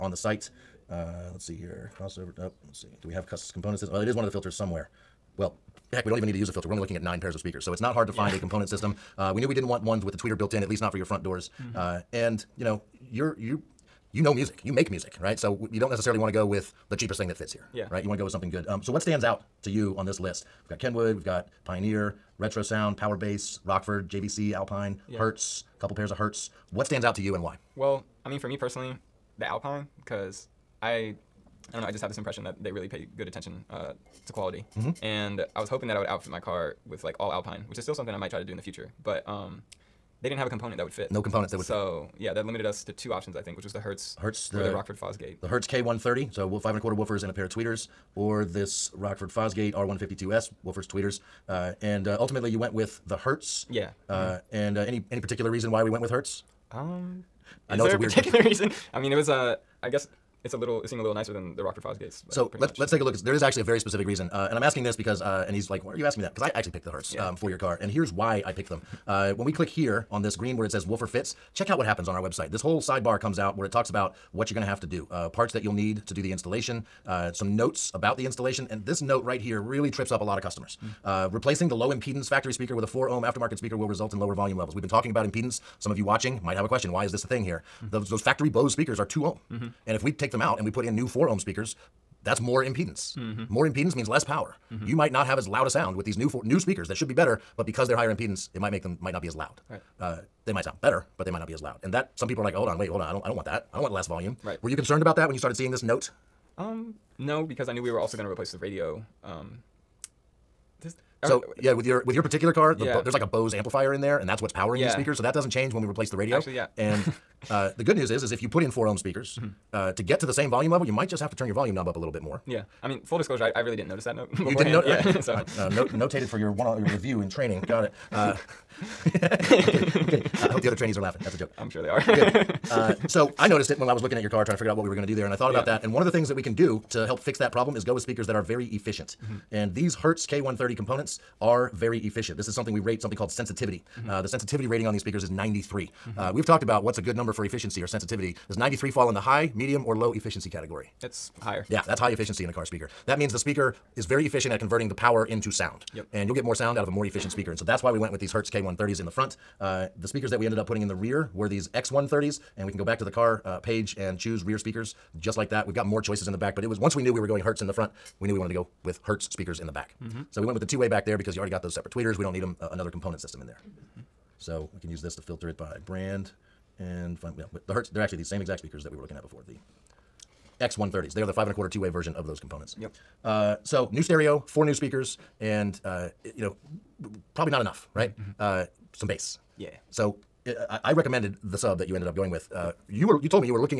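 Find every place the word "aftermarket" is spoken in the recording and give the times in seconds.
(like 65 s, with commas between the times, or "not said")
83 s.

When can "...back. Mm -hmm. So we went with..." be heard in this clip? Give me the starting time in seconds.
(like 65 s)
169 s.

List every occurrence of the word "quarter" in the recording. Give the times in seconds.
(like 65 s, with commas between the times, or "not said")
46 s, 181 s.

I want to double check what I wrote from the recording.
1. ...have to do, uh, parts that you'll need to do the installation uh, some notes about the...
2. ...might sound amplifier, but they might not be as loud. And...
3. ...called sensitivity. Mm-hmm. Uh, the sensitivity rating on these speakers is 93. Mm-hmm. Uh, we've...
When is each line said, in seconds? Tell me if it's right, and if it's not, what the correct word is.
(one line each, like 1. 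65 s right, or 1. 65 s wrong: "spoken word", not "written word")
1. 74 s right
2. 100 s wrong: "better", not "amplifier"
3. 143 s right.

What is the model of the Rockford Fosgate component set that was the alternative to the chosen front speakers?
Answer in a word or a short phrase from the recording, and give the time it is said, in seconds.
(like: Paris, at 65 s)
R152S, at 49 s.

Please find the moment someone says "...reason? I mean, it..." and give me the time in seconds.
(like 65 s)
58 s.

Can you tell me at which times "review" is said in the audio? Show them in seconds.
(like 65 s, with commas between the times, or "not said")
126 s.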